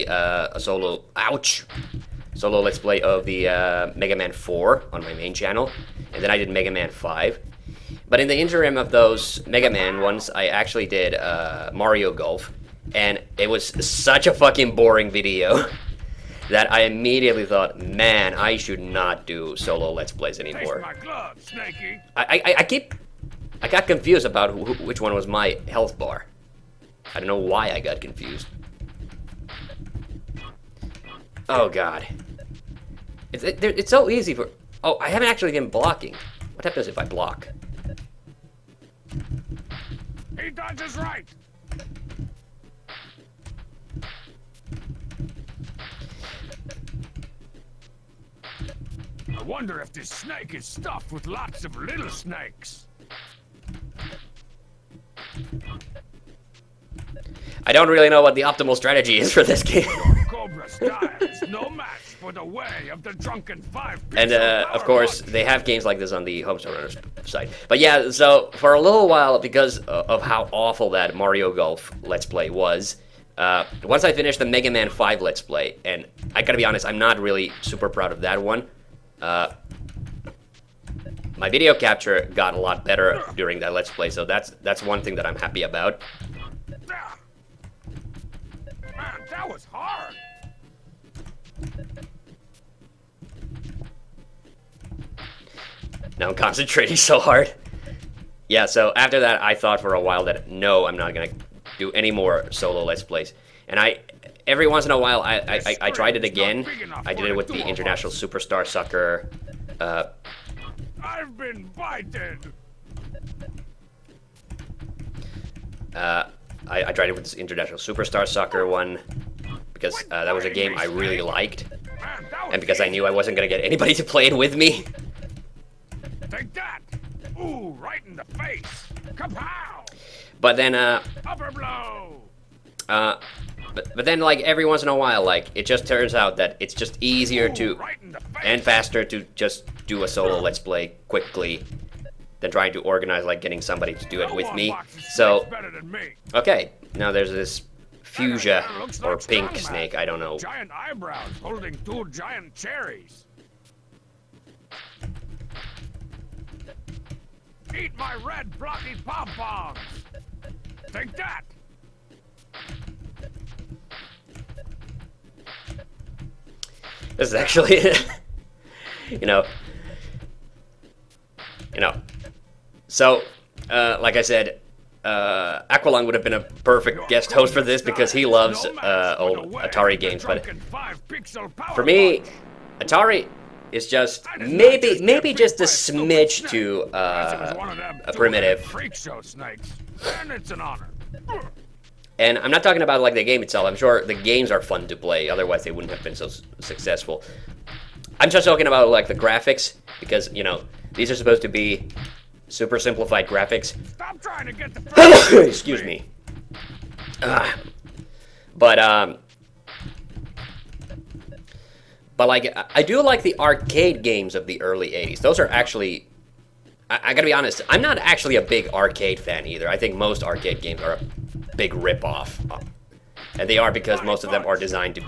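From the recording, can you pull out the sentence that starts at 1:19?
Uh, my video capture got a lot better during that let's play, so that's that's one thing that I'm happy about.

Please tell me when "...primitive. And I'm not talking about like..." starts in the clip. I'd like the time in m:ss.
3:08.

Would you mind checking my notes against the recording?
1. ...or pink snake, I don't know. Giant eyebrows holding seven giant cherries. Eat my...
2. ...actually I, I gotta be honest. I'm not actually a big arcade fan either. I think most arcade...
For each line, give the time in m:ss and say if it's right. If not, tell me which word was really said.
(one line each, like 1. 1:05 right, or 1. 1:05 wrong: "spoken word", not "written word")
1. 2:29 wrong: "two", not "seven"
2. 3:35 right.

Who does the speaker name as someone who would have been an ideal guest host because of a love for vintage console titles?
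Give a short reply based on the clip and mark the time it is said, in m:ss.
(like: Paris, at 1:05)
Aqualung, at 2:55.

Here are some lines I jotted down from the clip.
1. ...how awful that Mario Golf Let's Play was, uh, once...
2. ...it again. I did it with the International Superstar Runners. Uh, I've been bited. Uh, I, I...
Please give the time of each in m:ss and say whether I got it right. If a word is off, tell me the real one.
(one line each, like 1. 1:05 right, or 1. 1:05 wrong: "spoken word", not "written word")
1. 1:10 right
2. 1:46 wrong: "Soccer", not "Runners".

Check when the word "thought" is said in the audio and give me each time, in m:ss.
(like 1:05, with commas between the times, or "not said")
0:17, 1:39.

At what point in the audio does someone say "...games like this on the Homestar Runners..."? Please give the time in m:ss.
1:05.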